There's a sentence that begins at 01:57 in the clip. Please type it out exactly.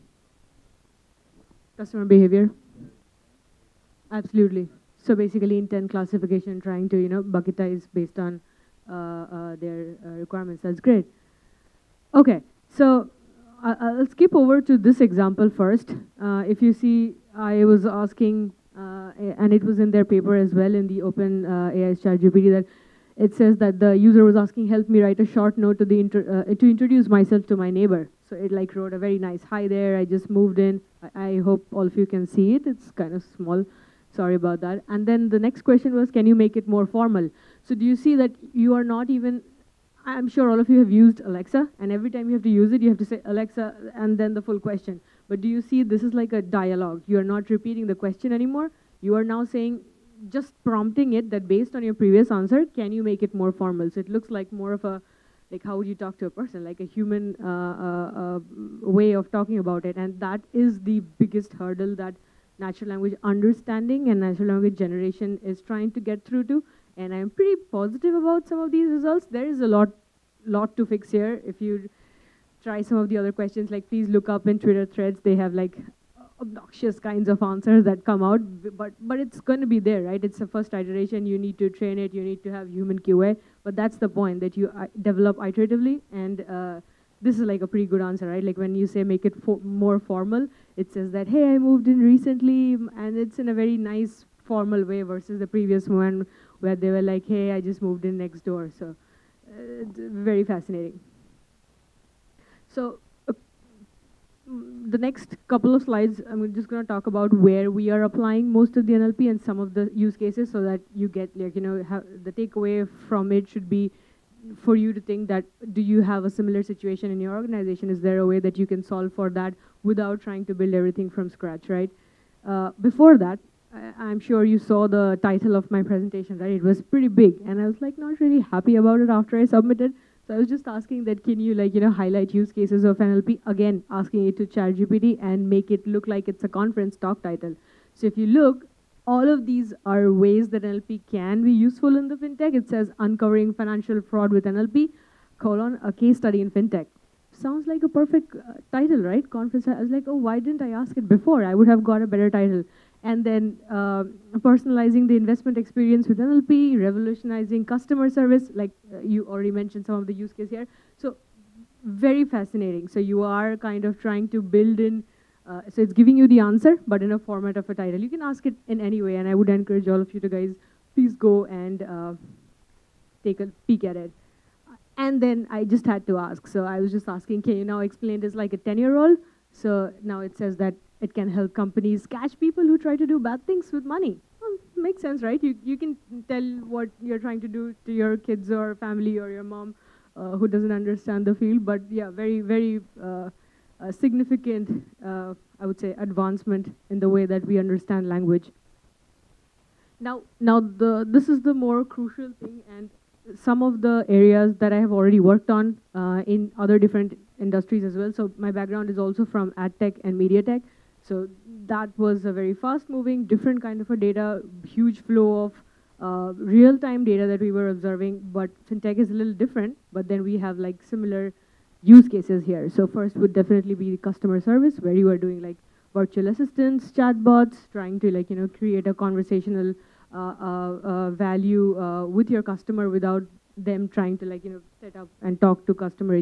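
Is there a way that you can solve for that without trying to build everything from scratch, right?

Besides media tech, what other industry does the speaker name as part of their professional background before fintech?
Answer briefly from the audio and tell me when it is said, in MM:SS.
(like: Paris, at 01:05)
Ad tech, at 03:29.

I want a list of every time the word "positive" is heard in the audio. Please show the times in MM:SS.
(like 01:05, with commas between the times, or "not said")
01:07.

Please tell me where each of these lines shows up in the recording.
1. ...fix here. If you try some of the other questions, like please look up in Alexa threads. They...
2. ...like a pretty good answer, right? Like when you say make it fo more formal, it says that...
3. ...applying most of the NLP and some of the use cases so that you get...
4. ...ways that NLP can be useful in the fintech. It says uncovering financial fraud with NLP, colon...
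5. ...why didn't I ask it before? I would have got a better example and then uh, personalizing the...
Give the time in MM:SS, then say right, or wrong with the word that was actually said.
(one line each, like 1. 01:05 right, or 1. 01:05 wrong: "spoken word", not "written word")
1. 01:10 wrong: "Twitter", not "Alexa"
2. 01:27 right
3. 01:48 right
4. 02:20 right
5. 02:30 wrong: "title", not "example".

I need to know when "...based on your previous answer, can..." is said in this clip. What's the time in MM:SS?
00:51.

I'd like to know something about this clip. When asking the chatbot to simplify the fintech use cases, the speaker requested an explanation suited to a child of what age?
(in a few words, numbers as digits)
10.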